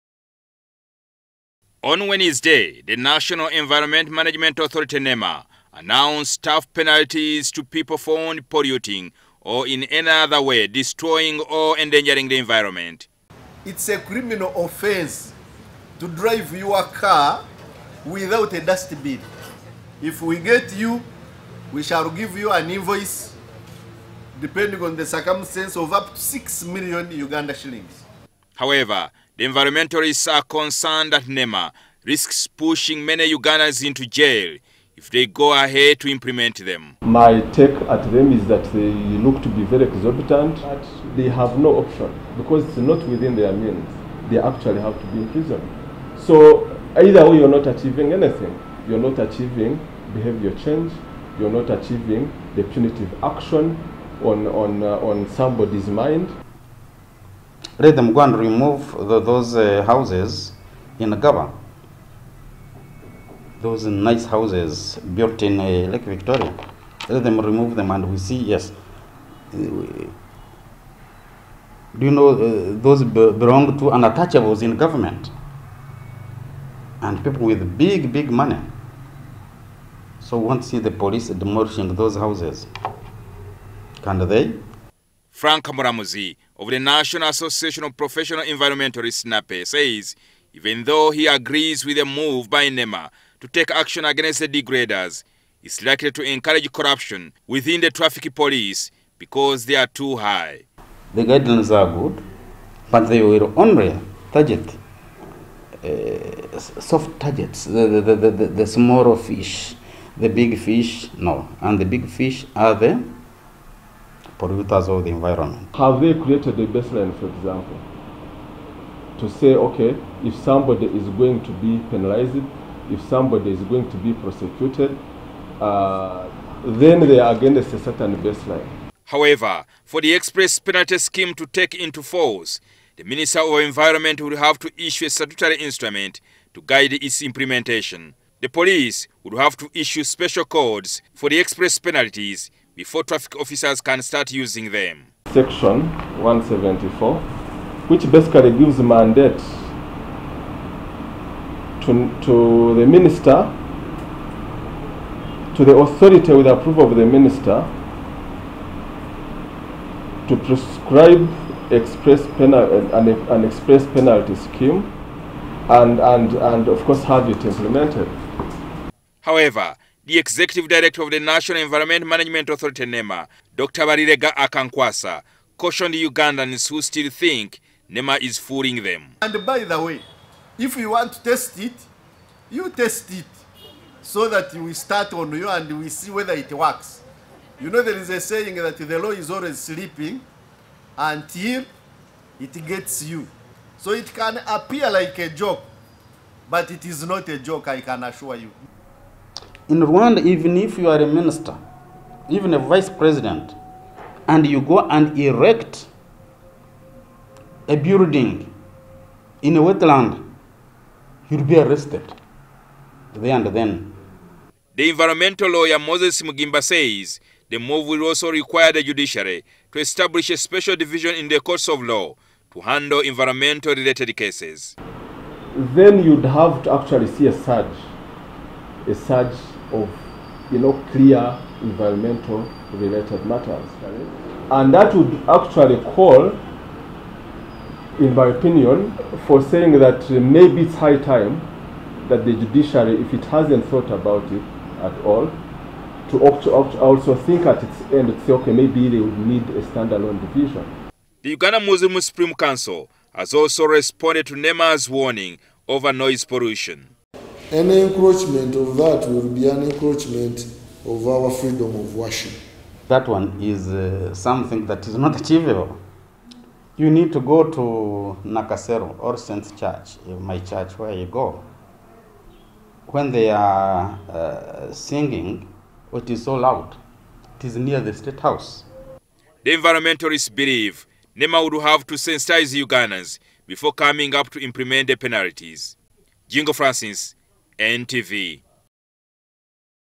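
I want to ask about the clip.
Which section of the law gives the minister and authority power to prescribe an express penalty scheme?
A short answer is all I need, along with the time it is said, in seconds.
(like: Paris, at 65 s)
Section 174, at 145 s.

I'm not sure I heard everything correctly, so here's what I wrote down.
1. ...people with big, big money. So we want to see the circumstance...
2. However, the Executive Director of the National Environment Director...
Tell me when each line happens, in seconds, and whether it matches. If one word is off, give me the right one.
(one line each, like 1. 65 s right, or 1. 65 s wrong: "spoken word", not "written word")
1. 77 s wrong: "police", not "circumstance"
2. 169 s wrong: "Management", not "Director".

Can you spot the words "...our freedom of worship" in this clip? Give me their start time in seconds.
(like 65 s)
261 s.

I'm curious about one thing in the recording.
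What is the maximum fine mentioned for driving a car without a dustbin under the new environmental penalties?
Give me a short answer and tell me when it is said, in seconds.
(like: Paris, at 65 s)
6 million Uganda shillings, at 26 s.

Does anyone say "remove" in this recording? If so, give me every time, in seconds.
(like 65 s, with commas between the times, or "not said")
58 s, 67 s.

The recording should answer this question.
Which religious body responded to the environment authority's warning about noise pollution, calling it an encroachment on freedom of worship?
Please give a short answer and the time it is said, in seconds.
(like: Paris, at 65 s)
Uganda Muslim Supreme Council, at 251 s.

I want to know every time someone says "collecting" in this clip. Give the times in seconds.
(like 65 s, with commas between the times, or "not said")
not said.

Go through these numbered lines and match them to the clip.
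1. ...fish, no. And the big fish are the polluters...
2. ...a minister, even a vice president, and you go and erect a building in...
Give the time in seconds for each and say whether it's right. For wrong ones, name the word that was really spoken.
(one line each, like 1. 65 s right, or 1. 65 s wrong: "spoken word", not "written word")
1. 110 s right
2. 201 s right.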